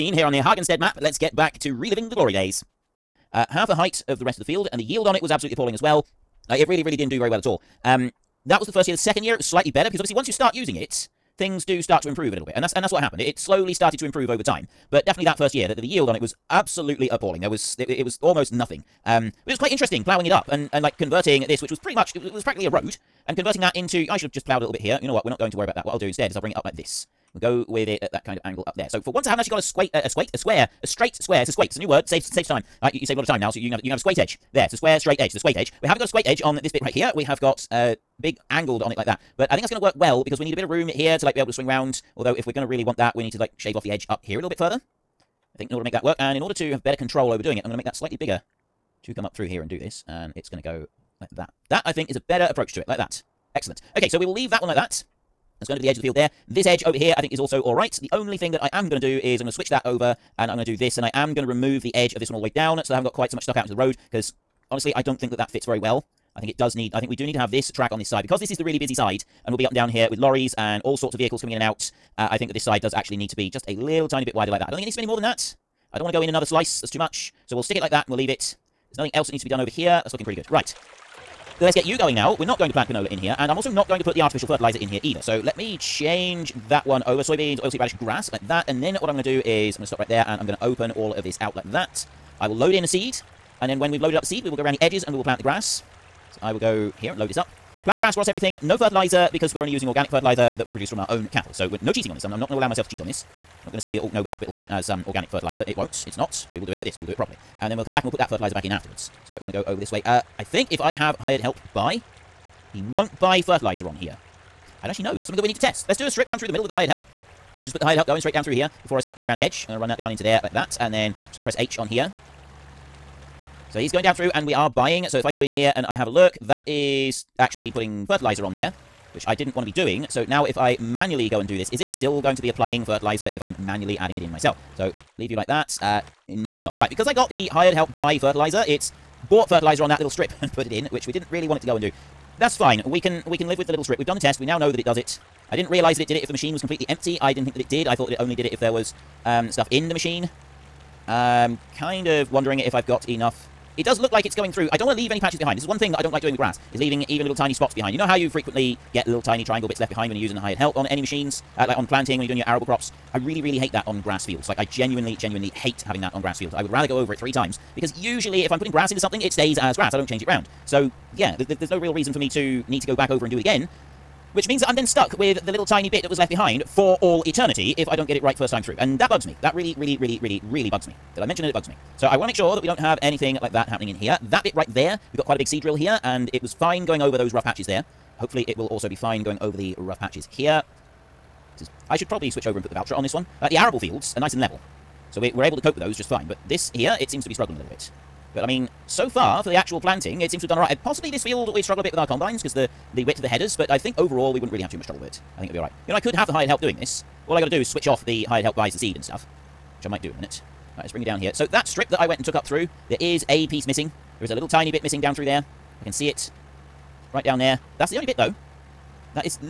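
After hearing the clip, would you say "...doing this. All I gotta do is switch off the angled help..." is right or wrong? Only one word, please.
wrong.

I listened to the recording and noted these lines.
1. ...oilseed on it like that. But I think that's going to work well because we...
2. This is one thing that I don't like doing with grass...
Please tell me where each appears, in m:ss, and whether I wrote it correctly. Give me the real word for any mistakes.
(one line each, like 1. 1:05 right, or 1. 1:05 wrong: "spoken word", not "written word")
1. 0:38 wrong: "angled", not "oilseed"
2. 2:35 right.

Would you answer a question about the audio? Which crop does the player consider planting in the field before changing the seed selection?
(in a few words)
canola.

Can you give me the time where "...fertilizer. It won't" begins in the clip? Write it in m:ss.
1:45.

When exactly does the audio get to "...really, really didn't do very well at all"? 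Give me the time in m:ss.
0:06.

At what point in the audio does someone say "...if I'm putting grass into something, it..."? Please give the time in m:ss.
2:48.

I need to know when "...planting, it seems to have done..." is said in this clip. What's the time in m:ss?
3:19.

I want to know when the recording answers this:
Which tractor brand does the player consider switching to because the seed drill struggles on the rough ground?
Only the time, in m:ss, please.
3:12.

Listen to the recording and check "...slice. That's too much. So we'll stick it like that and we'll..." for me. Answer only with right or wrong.
right.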